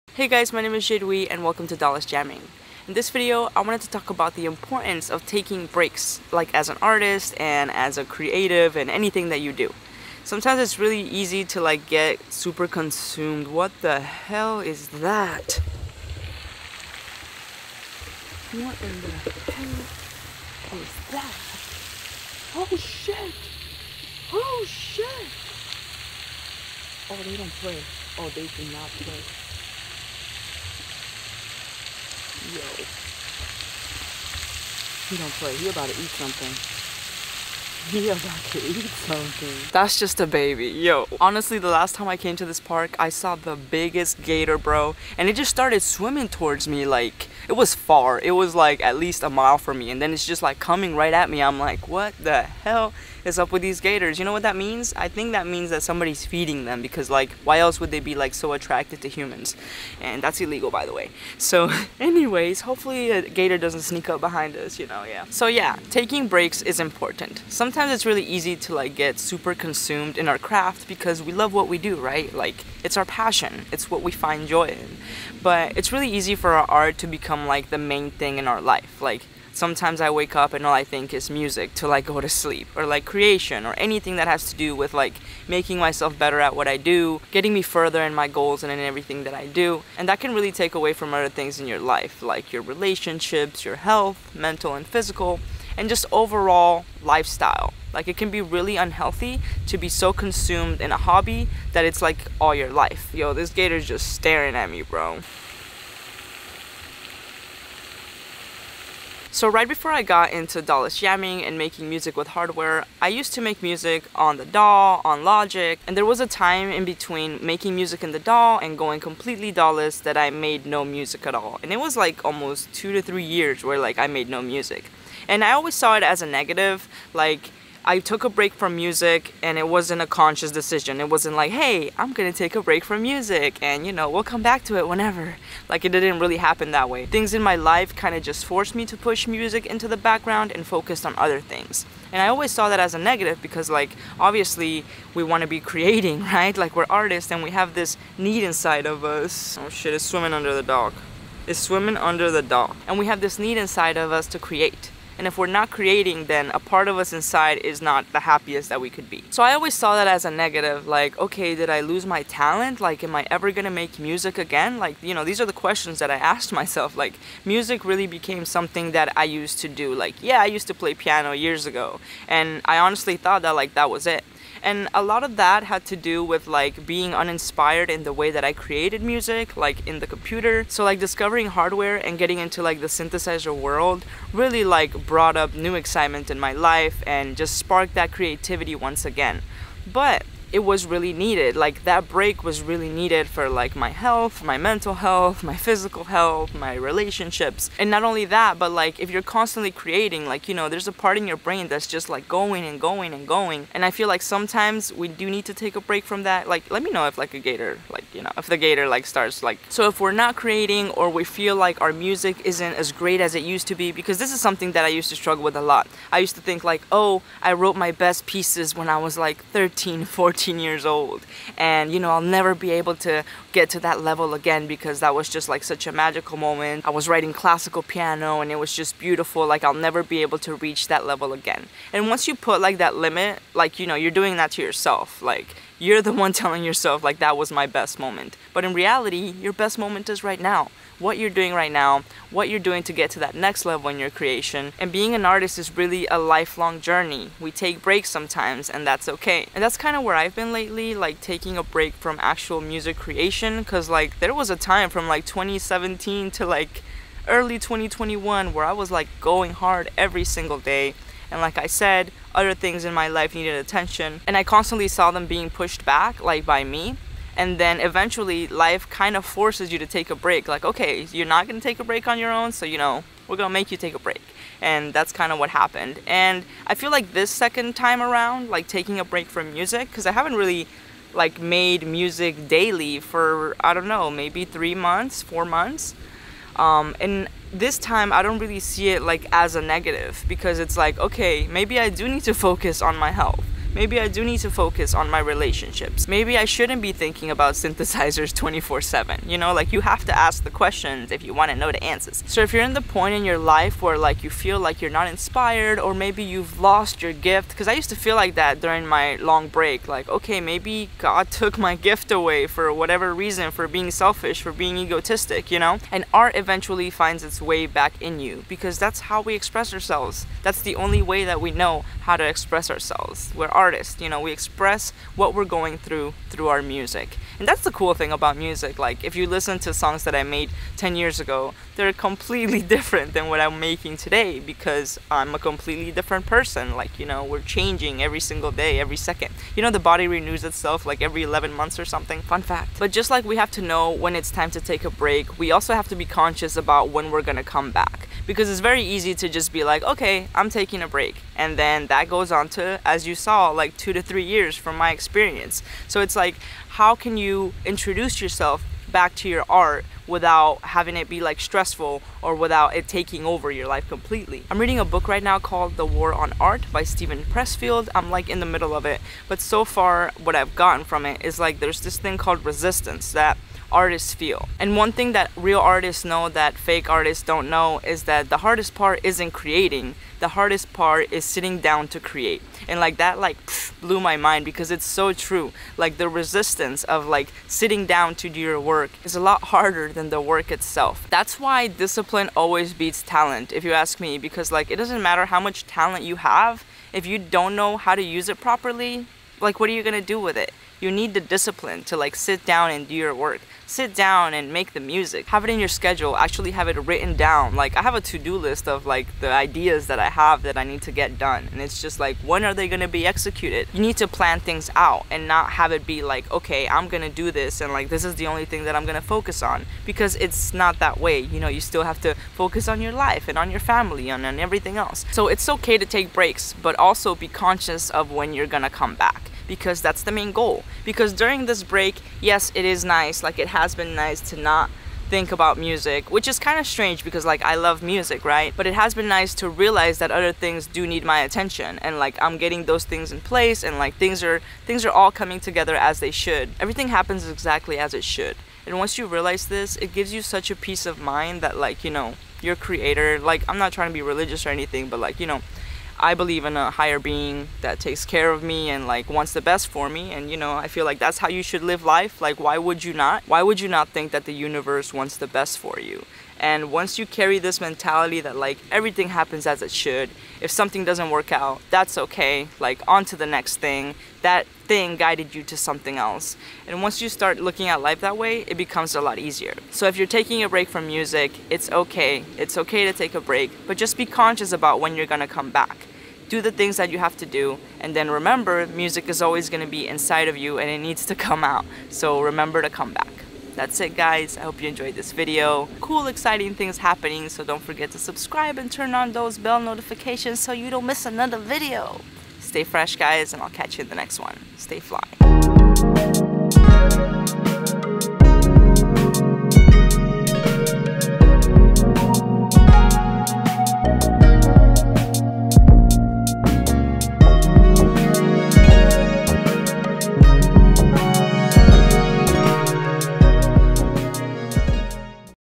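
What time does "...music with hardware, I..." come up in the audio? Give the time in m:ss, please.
1:51.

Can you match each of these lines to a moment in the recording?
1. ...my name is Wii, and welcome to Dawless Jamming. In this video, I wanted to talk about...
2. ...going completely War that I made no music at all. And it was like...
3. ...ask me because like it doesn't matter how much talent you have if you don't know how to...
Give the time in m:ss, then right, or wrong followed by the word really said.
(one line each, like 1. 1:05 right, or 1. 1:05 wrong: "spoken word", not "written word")
1. 0:00 right
2. 1:58 wrong: "Dawless", not "War"
3. 6:33 right.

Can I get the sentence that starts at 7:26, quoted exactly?
Everything happens exactly as it should.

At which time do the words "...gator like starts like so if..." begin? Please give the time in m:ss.
3:28.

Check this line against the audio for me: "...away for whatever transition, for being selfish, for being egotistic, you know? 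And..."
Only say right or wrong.
wrong.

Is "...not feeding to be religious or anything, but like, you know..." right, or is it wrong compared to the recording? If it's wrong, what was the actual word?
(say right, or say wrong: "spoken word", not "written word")
wrong: "trying", not "feeding".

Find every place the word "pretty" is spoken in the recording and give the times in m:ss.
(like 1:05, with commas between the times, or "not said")
not said.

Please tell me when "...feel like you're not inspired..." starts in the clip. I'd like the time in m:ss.
5:04.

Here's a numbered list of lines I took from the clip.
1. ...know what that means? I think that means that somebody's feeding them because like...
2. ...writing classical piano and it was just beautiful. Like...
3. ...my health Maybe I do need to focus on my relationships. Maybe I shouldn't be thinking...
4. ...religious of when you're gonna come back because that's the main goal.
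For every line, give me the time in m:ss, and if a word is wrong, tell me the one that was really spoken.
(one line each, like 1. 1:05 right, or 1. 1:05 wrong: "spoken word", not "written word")
1. 0:54 right
2. 3:47 right
3. 4:52 right
4. 7:07 wrong: "conscious", not "religious".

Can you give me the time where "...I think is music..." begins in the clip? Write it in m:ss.
1:20.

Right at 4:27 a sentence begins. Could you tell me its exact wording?
And then eventually, life kind of forces you to take a break.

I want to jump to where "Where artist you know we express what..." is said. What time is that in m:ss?
5:23.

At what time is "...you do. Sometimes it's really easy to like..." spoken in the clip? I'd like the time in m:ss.
0:09.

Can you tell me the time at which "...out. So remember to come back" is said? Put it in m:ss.
8:11.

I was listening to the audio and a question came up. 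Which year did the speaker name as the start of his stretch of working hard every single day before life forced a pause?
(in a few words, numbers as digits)
2017.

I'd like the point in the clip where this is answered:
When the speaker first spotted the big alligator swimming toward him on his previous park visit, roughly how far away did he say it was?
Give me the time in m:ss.
0:48.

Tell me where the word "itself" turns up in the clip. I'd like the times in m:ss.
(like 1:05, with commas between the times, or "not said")
5:40, 6:30.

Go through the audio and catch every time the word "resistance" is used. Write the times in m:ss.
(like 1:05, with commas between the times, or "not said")
6:12, 6:26.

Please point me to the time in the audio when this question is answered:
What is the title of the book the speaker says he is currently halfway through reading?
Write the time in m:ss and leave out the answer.
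6:05.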